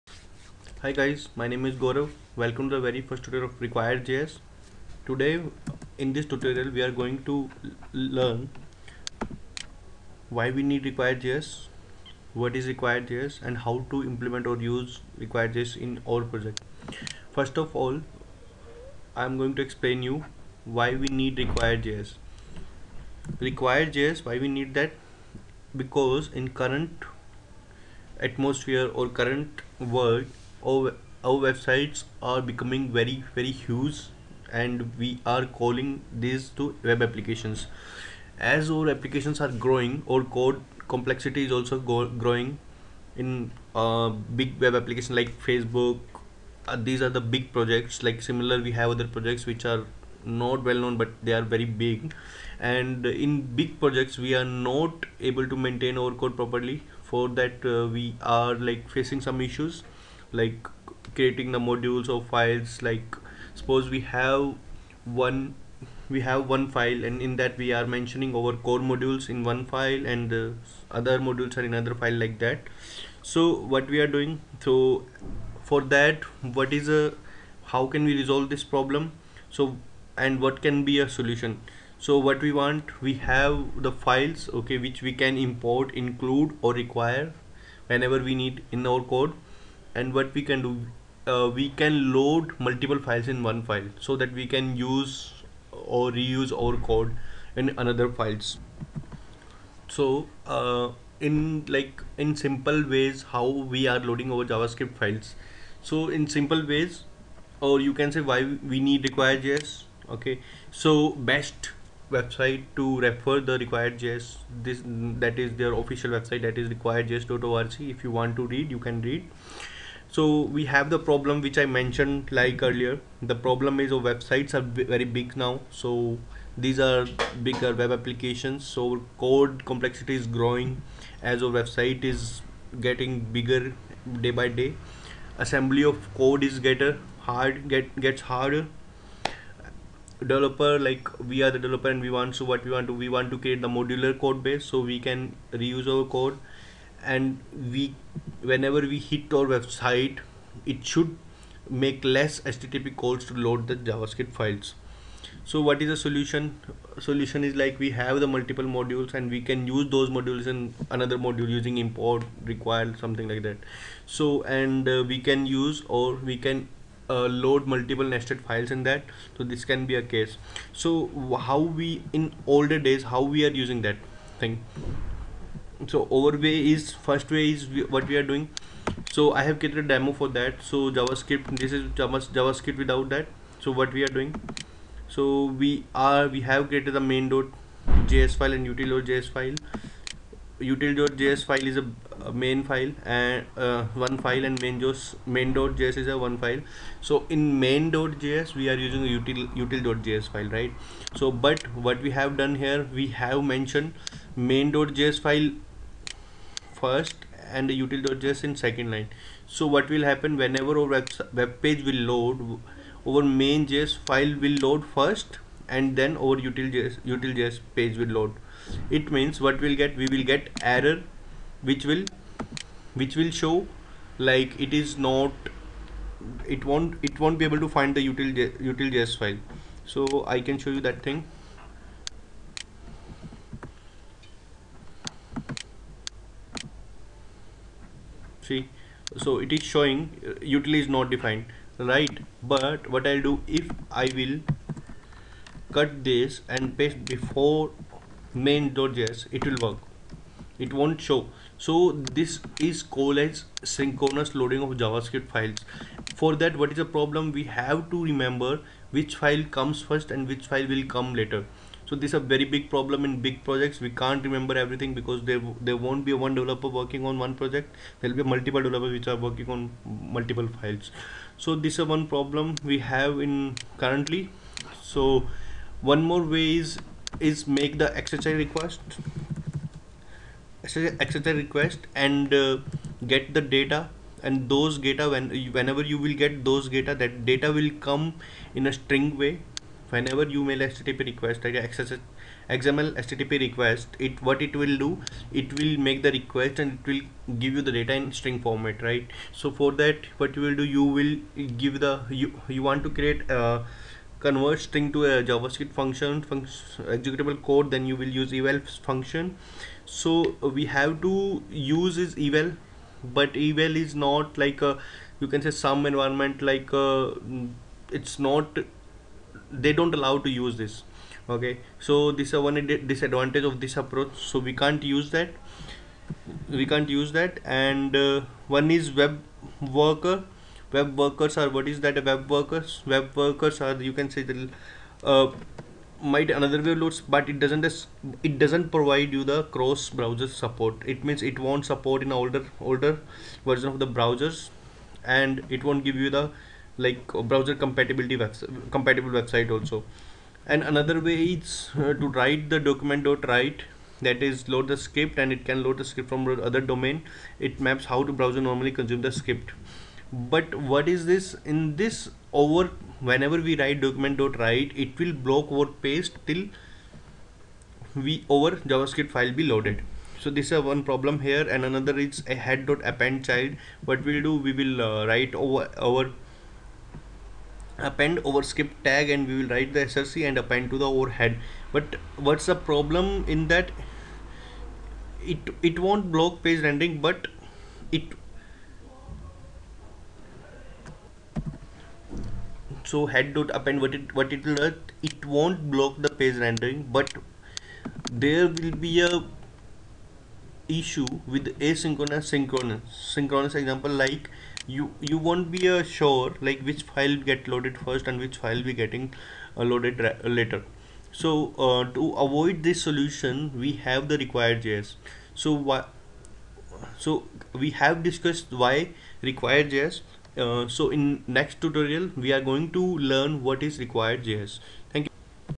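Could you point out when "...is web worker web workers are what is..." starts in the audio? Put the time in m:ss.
5:28.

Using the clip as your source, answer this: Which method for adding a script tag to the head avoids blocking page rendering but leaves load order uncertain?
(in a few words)
append child.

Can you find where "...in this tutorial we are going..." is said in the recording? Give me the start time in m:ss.
0:05.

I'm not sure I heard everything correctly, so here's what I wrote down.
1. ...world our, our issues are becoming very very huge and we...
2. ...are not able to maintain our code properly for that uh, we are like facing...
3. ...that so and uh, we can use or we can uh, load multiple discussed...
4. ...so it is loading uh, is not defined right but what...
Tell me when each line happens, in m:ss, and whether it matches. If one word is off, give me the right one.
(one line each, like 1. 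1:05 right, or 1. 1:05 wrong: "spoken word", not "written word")
1. 0:29 wrong: "websites", not "issues"
2. 0:54 right
3. 2:43 wrong: "nested", not "discussed"
4. 3:59 wrong: "showing", not "loading".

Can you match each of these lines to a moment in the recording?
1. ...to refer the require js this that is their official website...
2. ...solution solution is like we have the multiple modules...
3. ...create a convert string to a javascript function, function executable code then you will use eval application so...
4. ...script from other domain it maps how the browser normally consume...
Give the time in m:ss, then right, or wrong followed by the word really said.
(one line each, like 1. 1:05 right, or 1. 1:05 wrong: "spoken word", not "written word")
1. 1:52 right
2. 2:35 right
3. 5:03 wrong: "function", not "application"
4. 5:55 right.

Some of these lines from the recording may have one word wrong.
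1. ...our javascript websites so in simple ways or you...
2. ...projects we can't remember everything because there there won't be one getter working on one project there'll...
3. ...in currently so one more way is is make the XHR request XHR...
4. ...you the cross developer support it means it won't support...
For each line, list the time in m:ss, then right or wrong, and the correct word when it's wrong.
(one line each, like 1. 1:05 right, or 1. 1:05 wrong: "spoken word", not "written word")
1. 1:44 wrong: "files", not "websites"
2. 4:23 wrong: "developer", not "getter"
3. 4:33 right
4. 5:39 wrong: "browser", not "developer".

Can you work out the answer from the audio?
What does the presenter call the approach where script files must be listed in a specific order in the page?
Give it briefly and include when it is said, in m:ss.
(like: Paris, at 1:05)
synchronous loading, at 4:13.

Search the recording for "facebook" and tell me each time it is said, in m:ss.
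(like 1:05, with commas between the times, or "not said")
0:45.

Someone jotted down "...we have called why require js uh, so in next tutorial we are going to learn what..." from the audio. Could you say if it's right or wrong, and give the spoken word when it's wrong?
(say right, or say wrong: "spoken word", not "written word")
wrong: "discussed", not "called".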